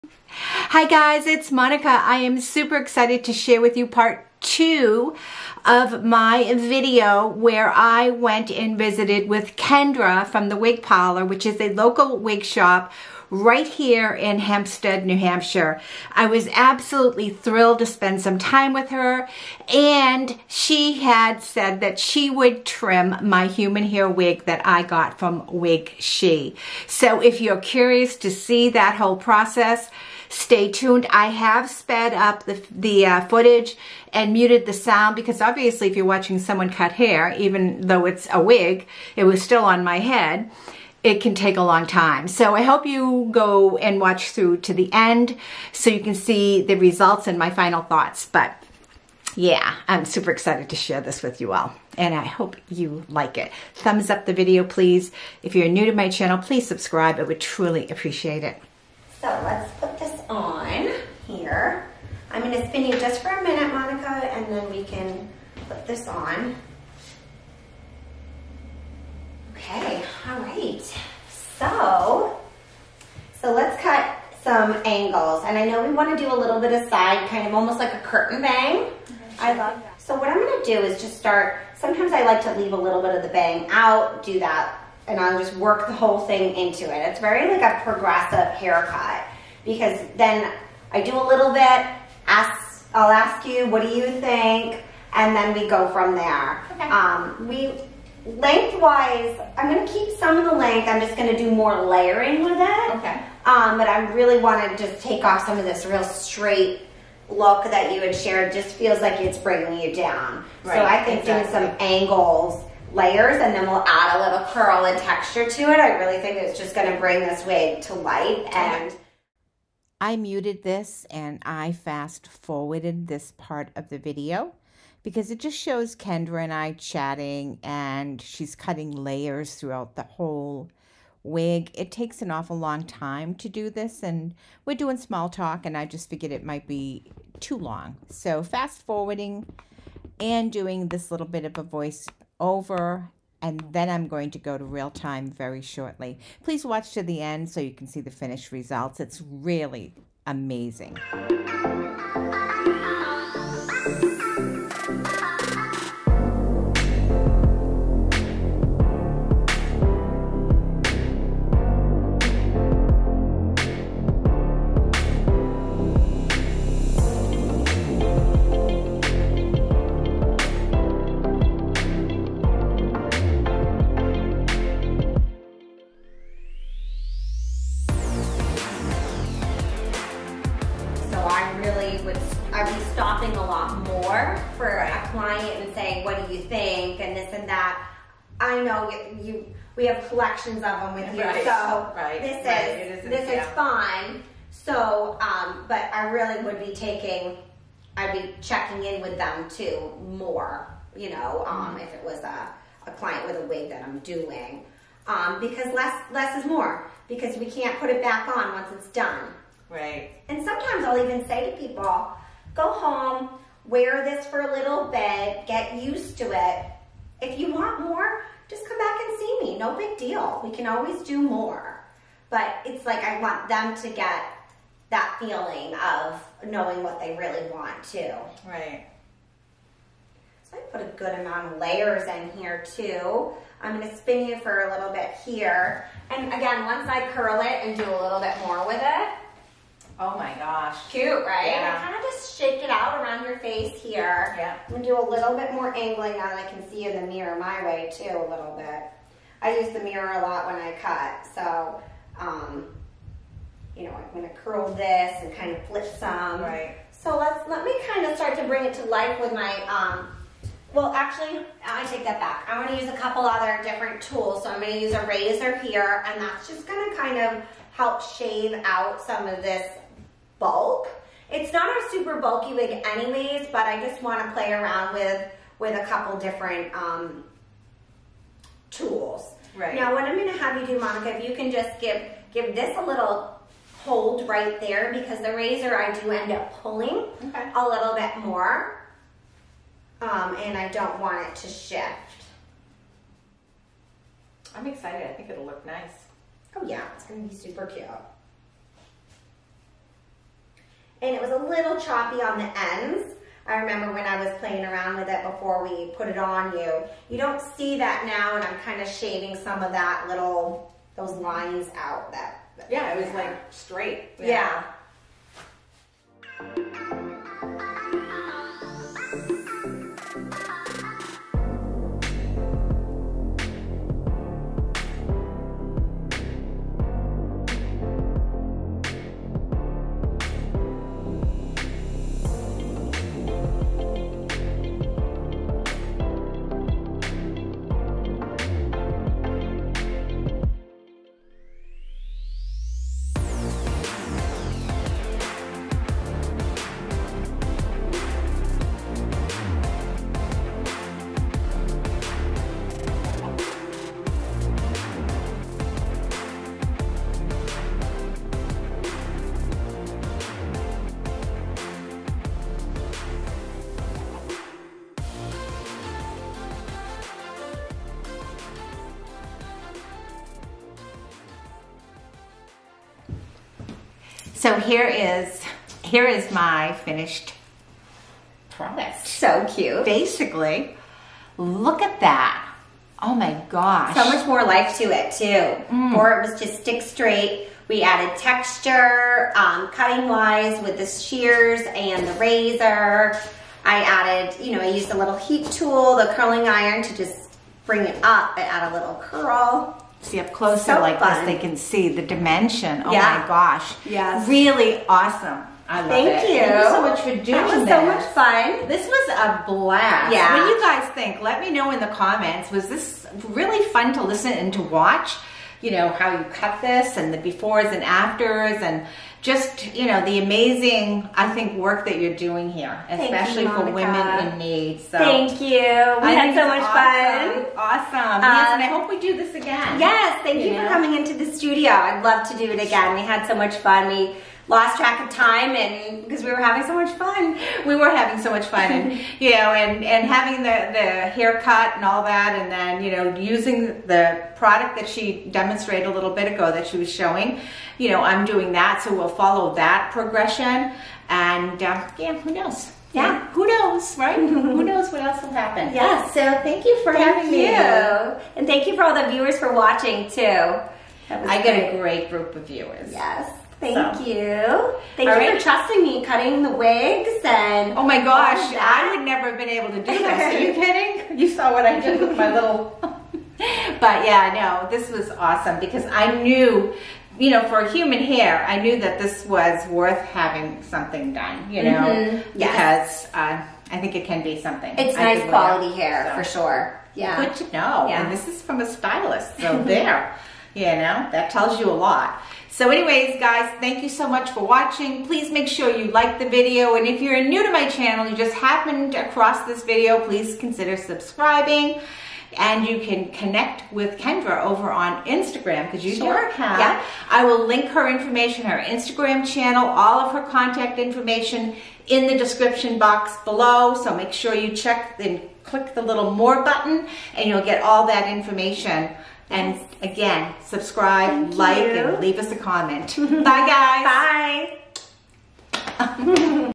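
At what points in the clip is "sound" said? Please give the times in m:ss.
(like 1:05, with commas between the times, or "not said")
0:34.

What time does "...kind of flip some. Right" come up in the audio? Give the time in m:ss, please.
4:15.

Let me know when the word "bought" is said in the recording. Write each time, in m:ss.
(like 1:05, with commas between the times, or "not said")
not said.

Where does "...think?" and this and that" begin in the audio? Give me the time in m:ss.
3:06.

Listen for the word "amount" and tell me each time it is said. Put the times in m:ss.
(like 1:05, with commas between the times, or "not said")
3:51.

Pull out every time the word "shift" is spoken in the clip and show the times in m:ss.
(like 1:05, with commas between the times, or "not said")
4:51.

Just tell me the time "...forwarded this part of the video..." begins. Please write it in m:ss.
2:02.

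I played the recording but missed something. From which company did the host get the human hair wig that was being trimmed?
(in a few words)
WigShe.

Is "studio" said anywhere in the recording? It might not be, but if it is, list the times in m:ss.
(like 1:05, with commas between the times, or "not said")
7:11.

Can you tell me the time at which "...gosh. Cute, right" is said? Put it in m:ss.
4:00.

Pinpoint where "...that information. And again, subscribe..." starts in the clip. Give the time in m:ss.
8:37.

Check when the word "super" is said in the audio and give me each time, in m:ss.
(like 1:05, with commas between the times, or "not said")
0:02, 0:50, 4:31, 4:57.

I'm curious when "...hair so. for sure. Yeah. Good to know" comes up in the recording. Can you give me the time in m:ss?
8:05.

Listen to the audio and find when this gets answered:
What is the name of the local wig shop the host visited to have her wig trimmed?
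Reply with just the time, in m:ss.
0:10.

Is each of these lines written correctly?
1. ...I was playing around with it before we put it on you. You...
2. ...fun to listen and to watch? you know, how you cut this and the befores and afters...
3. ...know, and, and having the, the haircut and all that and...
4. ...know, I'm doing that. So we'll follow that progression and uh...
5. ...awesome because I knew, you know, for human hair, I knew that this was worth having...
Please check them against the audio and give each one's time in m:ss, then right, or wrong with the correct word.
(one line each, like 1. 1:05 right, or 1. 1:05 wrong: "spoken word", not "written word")
1. 5:04 right
2. 6:53 right
3. 7:19 right
4. 7:27 right
5. 7:55 right.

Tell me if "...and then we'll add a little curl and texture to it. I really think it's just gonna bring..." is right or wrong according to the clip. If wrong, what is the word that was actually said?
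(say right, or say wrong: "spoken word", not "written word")
right.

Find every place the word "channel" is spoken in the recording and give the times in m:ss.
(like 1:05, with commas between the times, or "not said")
0:56, 8:17, 8:29.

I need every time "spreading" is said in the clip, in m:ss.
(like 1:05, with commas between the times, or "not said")
not said.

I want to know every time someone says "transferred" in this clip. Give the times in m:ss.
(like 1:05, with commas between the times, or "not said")
not said.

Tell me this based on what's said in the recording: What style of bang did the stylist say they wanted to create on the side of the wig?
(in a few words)
Curtain bang.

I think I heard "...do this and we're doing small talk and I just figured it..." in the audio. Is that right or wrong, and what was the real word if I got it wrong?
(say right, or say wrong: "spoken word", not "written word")
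right.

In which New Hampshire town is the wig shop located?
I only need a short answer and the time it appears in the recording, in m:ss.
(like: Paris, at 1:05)
Hampstead, at 0:14.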